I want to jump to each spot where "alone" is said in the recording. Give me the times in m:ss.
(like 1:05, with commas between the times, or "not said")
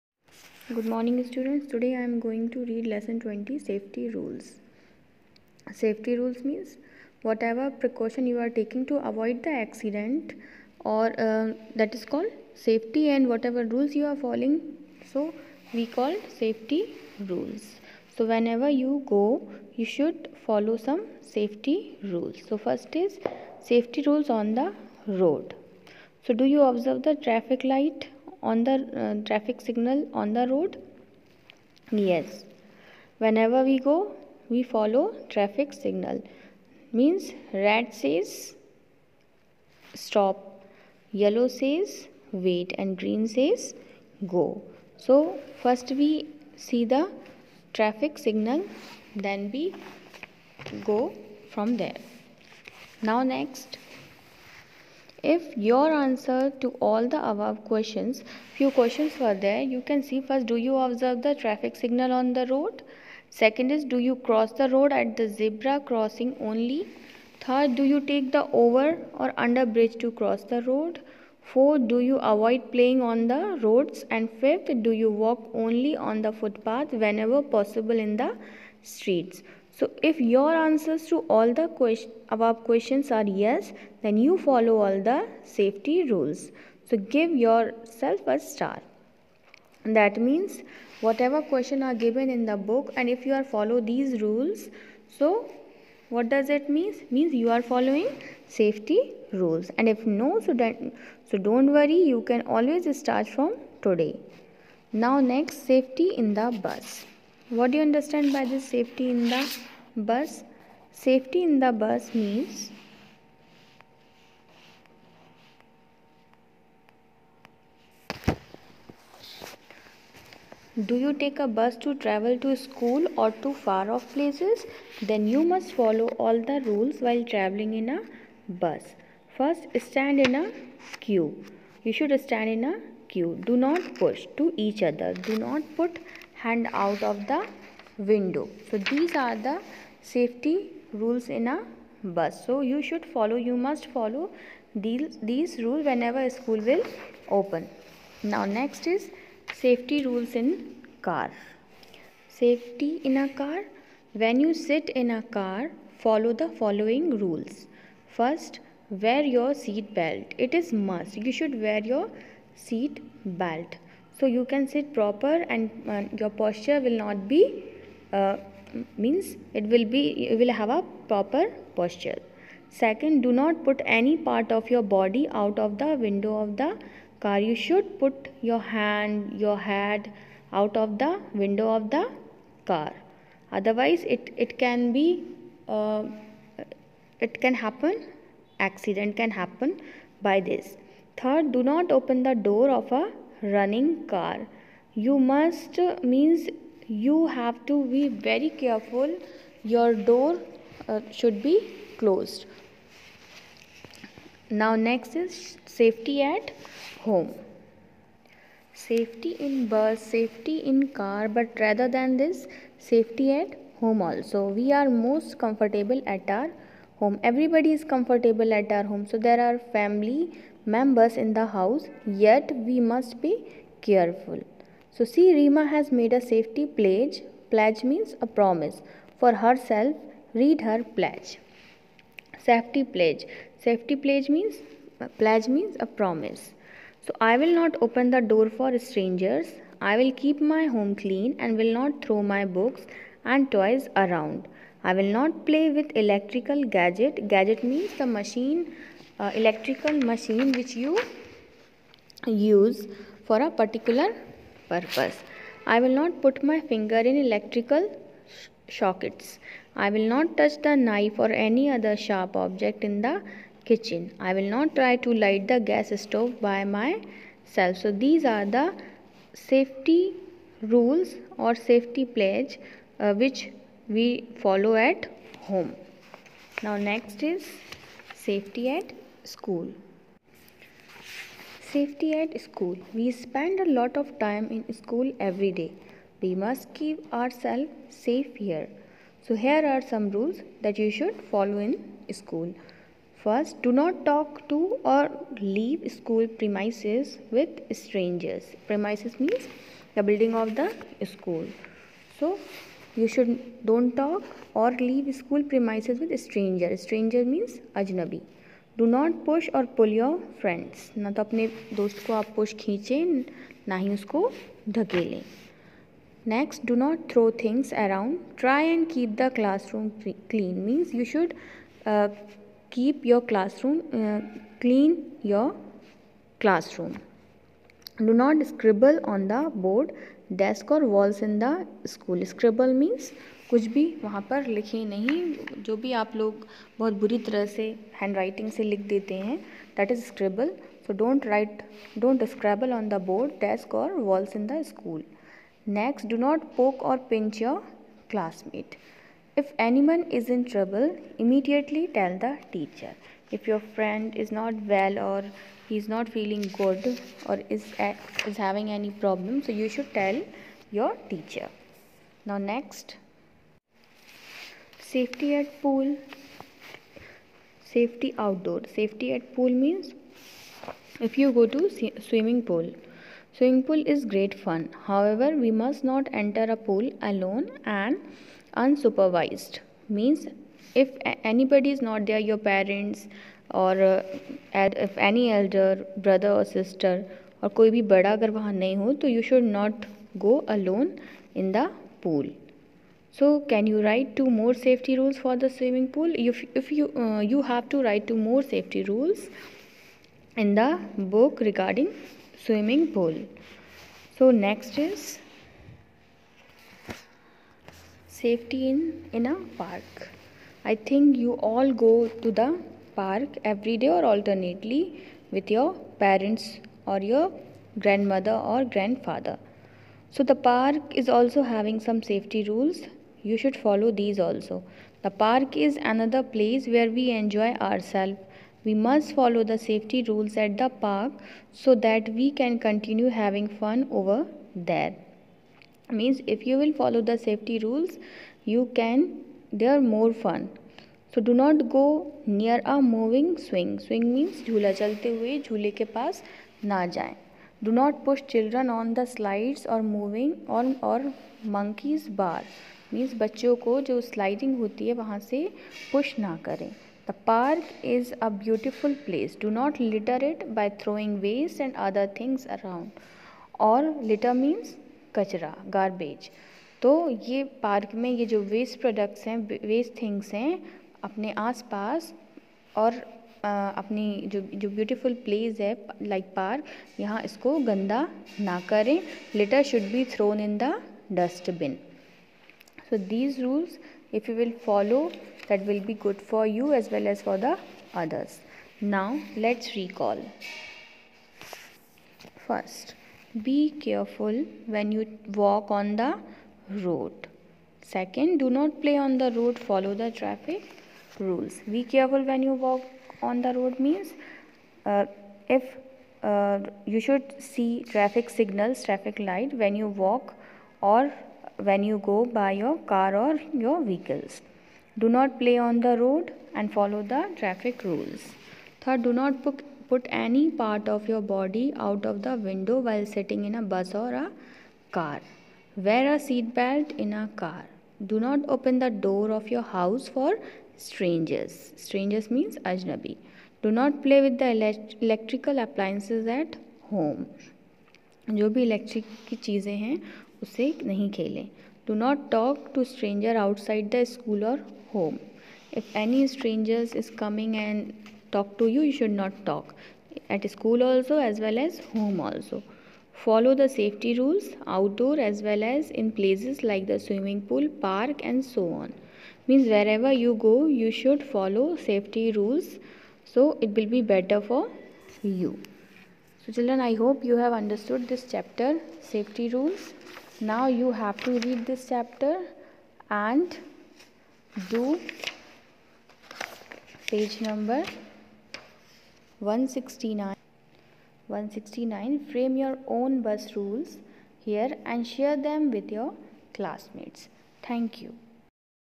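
6:17, 6:30.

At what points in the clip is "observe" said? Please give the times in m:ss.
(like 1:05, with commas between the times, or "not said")
0:26, 1:00.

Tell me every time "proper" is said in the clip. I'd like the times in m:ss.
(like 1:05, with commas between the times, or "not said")
2:44, 2:51.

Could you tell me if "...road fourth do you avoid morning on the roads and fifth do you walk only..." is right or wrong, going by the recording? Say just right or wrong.
wrong.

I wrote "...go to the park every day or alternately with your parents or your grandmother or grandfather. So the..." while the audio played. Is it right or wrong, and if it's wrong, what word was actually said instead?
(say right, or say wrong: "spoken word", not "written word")
right.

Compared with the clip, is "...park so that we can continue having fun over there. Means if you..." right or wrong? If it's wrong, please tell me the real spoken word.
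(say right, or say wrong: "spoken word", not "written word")
right.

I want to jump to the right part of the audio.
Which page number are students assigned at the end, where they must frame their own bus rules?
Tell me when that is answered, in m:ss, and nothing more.
9:37.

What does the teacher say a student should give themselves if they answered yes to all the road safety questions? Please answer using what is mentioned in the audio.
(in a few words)
a star.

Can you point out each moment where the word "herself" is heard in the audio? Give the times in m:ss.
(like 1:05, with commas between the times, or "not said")
3:49.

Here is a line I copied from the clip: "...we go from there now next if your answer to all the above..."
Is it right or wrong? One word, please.
right.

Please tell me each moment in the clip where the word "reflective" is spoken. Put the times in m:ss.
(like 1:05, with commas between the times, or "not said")
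not said.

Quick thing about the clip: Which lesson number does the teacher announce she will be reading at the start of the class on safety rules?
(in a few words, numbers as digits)
20.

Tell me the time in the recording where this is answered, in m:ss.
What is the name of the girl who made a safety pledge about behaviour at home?
3:45.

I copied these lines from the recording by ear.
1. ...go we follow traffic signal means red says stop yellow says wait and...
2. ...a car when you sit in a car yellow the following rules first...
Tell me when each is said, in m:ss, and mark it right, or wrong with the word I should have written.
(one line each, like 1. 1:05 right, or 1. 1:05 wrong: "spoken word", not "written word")
1. 0:33 right
2. 2:33 wrong: "follow", not "yellow".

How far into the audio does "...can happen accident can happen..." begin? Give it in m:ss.
3:07.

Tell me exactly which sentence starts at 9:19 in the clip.
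Means wherever you go you should follow safety rules so it will be better for you.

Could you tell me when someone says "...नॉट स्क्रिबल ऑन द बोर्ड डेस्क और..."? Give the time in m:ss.
5:28.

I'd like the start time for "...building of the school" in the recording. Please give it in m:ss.
5:00.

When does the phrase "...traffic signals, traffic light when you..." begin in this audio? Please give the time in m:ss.
8:27.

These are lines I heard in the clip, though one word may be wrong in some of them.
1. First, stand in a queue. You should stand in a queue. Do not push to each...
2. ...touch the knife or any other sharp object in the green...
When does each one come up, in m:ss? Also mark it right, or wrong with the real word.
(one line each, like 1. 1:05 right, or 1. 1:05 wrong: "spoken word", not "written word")
1. 2:09 right
2. 4:20 wrong: "kitchen", not "green".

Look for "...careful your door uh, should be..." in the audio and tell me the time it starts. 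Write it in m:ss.
3:18.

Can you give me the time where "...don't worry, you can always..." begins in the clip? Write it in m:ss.
1:41.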